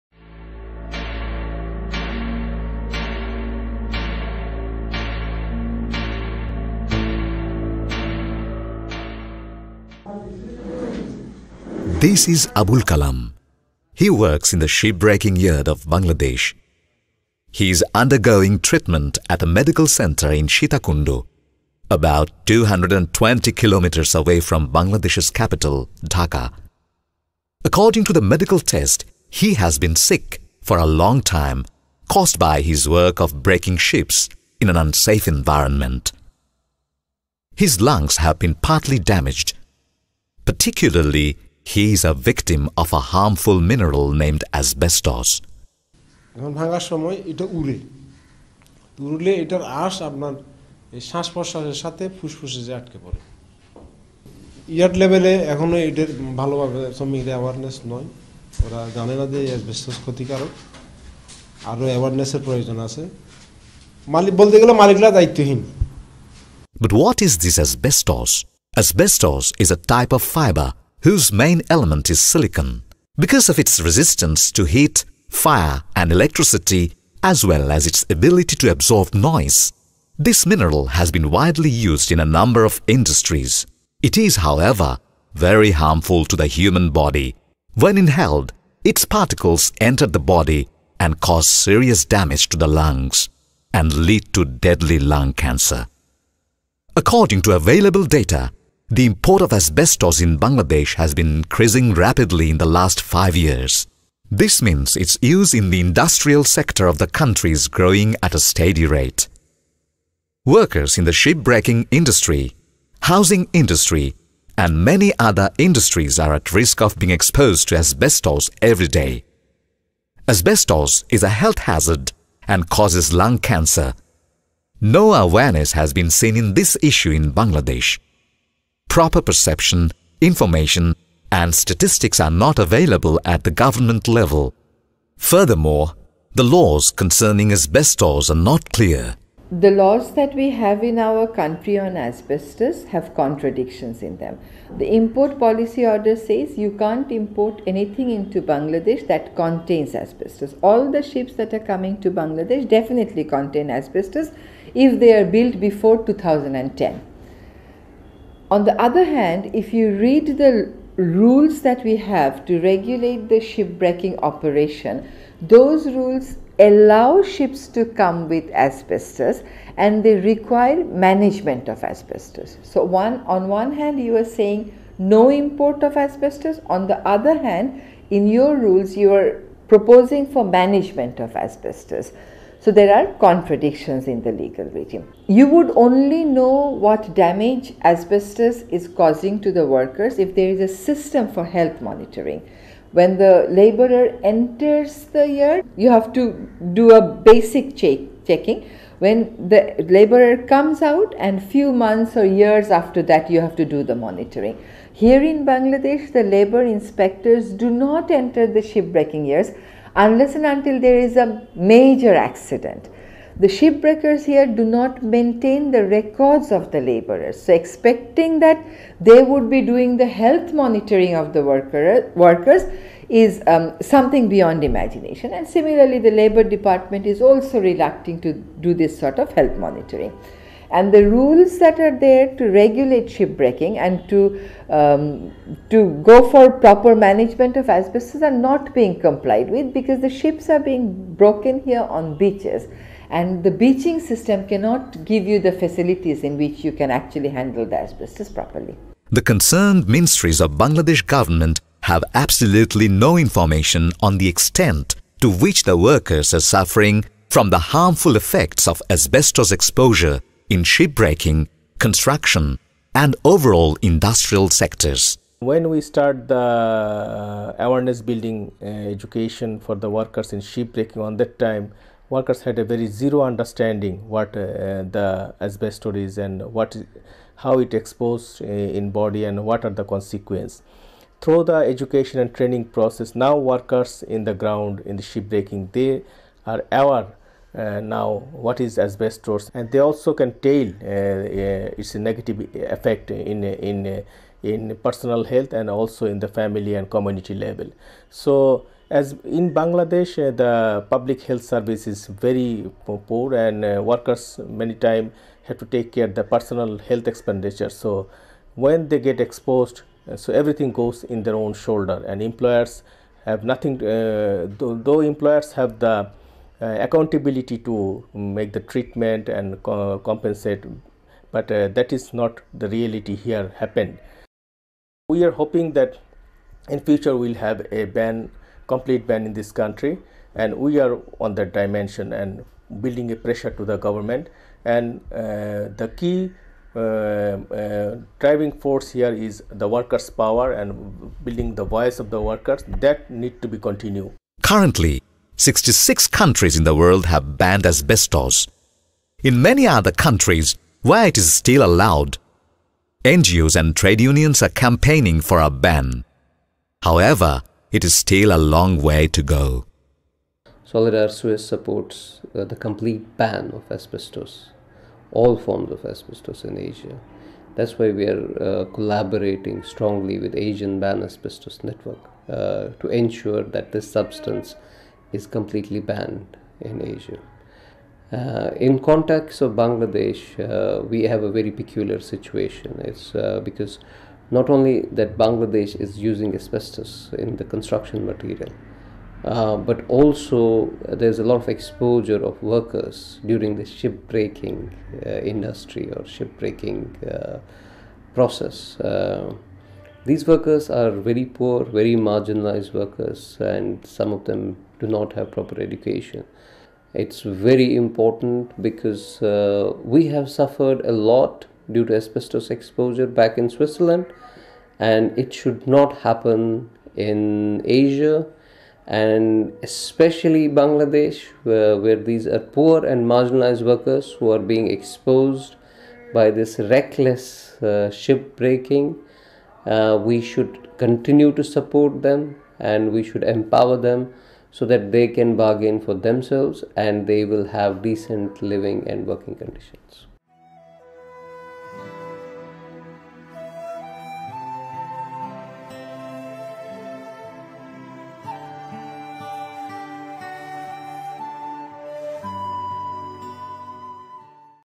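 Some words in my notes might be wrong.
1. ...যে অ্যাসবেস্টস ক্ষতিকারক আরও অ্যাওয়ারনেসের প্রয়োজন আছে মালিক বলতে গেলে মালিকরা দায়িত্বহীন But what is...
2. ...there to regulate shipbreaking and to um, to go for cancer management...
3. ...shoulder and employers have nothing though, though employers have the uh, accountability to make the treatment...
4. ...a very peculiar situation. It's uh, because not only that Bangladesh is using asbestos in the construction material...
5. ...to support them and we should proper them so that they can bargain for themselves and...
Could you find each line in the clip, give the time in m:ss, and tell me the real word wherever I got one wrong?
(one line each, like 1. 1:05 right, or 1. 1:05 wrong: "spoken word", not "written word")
1. 0:59 right
2. 3:51 wrong: "proper", not "cancer"
3. 5:11 right
4. 6:21 right
5. 7:11 wrong: "empower", not "proper".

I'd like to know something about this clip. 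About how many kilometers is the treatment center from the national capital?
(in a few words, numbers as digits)
220 kilometers.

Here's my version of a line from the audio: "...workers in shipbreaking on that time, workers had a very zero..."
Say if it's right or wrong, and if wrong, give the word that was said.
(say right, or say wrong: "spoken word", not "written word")
right.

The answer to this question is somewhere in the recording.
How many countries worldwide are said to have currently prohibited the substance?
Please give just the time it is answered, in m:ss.
5:45.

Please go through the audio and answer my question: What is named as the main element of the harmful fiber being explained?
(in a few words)
silicon.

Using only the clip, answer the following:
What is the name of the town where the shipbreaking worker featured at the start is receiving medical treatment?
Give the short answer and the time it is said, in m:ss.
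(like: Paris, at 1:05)
Sitakundu, at 0:20.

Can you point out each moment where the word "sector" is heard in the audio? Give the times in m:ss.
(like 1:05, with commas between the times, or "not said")
1:46, 4:24.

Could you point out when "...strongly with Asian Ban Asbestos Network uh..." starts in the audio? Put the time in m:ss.
6:09.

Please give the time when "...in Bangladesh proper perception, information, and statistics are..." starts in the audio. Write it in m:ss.
2:07.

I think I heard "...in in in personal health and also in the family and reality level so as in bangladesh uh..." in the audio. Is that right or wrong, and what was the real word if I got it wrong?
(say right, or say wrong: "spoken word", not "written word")
wrong: "community", not "reality".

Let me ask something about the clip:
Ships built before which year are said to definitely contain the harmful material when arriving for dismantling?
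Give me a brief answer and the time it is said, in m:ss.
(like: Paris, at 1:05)
2010, at 2:36.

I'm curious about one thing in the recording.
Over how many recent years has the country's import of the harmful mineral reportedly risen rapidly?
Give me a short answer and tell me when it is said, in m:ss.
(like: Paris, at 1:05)
5, at 1:42.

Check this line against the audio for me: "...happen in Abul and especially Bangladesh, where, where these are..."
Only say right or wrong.
wrong.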